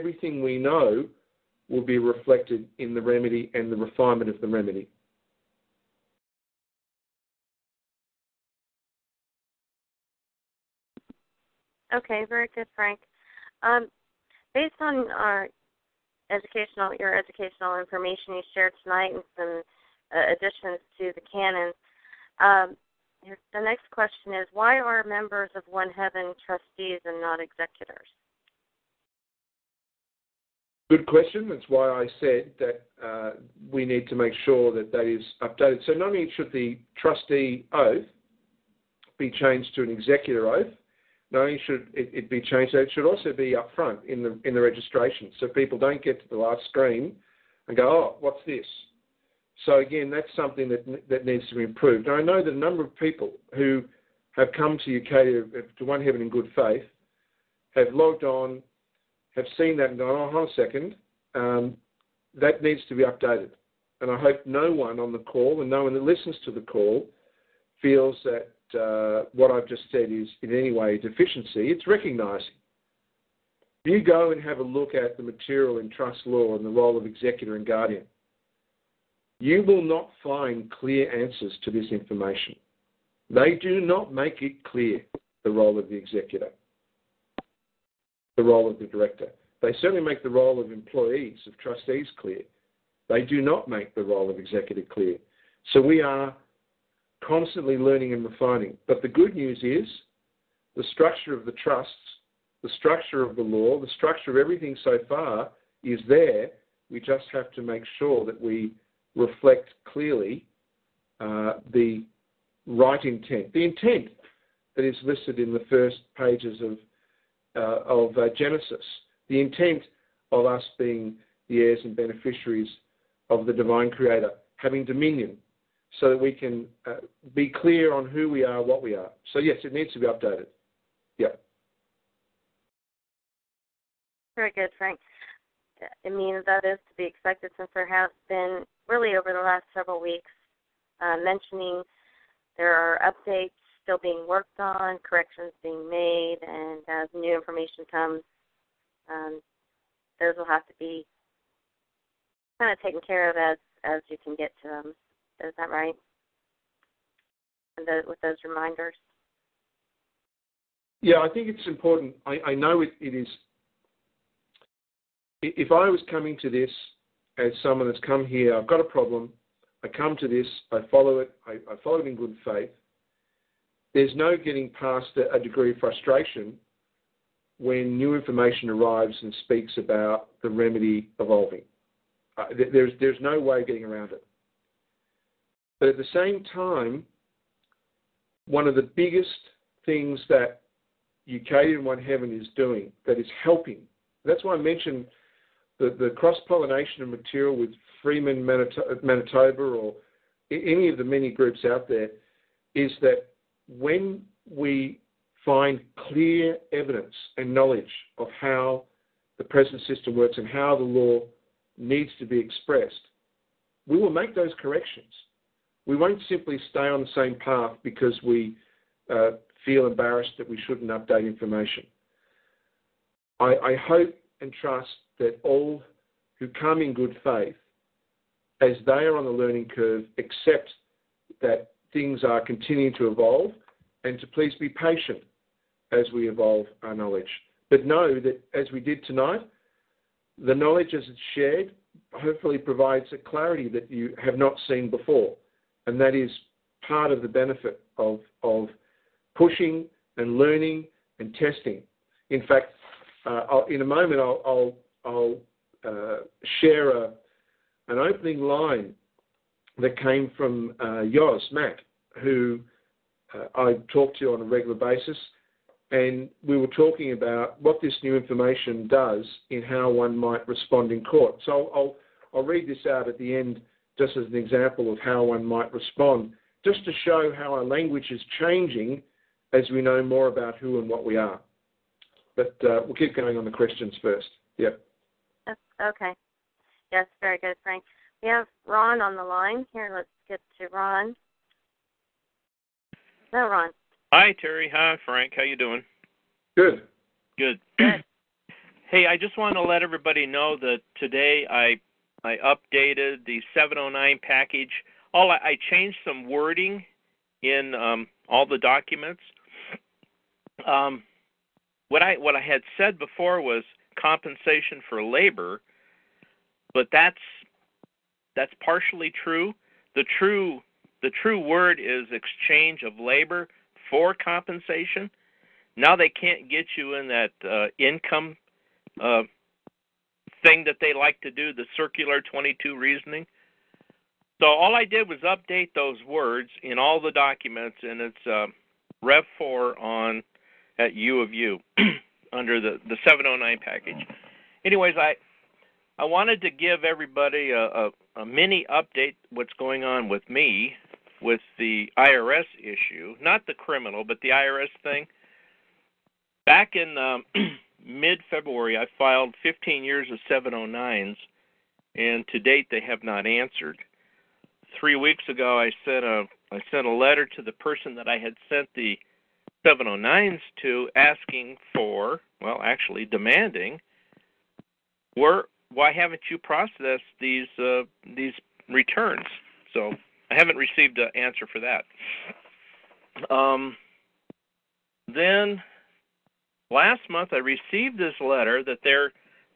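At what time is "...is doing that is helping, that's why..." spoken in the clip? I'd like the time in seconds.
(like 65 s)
192 s.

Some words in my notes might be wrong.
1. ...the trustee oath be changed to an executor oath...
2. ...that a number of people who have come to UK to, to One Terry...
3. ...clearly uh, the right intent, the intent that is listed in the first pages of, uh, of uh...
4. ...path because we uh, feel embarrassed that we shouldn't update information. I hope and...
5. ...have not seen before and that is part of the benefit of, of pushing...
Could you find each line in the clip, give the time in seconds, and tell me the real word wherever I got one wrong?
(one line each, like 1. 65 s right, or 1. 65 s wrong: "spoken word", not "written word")
1. 36 s right
2. 52 s wrong: "Heaven", not "Terry"
3. 109 s right
4. 217 s right
5. 244 s right.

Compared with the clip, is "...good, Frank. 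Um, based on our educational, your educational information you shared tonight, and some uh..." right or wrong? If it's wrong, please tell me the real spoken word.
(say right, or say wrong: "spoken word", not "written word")
right.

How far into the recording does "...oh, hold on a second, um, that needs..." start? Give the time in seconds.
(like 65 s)
60 s.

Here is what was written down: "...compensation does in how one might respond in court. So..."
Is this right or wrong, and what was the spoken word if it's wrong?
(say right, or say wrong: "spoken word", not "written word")
wrong: "information", not "compensation".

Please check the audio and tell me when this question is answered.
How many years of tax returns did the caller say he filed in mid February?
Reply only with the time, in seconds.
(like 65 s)
359 s.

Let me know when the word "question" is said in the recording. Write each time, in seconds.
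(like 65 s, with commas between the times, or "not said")
23 s, 31 s, 283 s.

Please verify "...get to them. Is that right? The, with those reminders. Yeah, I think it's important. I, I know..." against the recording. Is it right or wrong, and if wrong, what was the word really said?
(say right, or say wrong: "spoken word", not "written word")
right.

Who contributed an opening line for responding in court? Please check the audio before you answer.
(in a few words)
Yoz, Matt.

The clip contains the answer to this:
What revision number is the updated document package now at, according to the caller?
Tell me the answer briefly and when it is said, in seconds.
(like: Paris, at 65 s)
Rev 4, at 339 s.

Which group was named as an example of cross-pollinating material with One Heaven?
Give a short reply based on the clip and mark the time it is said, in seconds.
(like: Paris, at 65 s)
Freeman Manitoba, at 198 s.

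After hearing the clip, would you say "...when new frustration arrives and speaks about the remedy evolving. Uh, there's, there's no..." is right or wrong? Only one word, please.
wrong.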